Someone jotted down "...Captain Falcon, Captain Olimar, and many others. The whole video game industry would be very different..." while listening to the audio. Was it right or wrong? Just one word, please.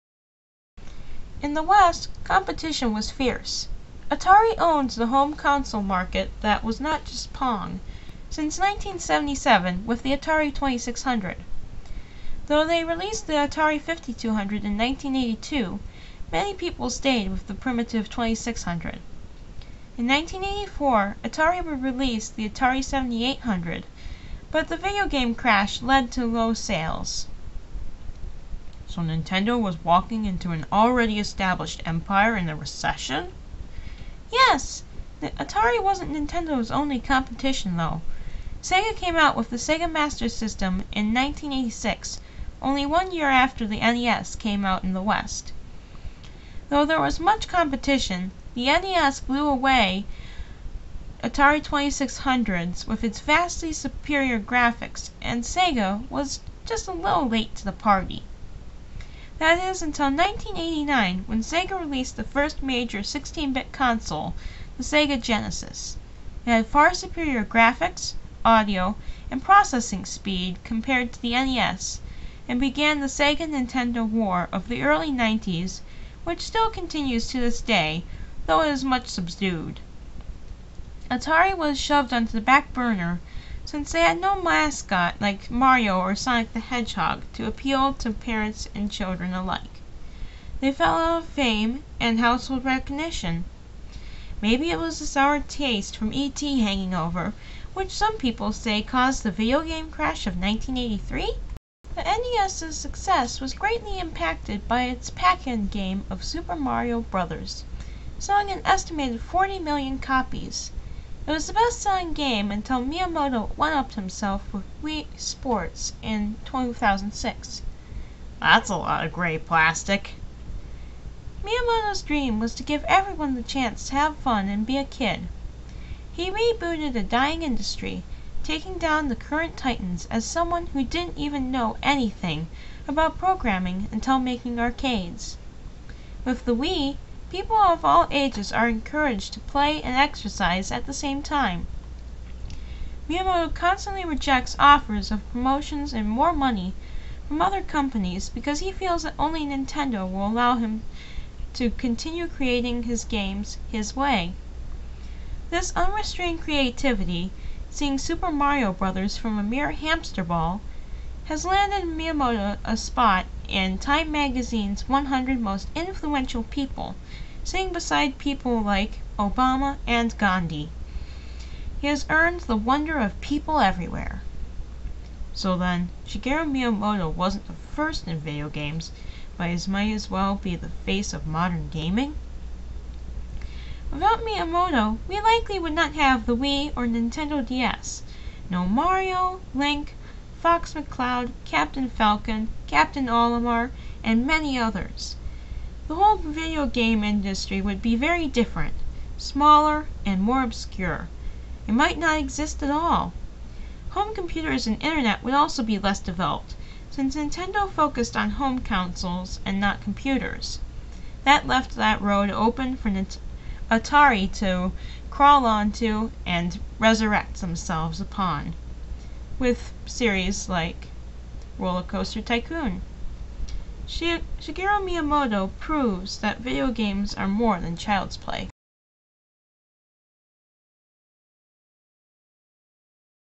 right.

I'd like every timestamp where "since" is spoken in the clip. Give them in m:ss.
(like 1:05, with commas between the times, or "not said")
0:08, 1:23, 3:26.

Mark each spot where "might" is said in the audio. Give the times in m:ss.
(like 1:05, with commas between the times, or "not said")
2:59, 3:21.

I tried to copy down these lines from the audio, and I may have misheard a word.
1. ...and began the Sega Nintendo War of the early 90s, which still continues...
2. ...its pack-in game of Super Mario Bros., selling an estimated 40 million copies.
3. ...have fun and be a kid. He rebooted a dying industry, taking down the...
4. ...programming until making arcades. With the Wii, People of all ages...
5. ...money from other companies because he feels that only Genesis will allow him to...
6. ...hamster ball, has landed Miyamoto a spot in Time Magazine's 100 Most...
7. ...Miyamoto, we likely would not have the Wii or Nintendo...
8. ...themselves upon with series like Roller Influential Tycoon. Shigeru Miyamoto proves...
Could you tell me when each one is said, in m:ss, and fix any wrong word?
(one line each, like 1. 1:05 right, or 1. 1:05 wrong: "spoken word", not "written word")
1. 1:12 right
2. 1:44 right
3. 2:03 right
4. 2:13 right
5. 2:26 wrong: "Nintendo", not "Genesis"
6. 2:39 right
7. 3:04 right
8. 3:37 wrong: "Coaster", not "Influential".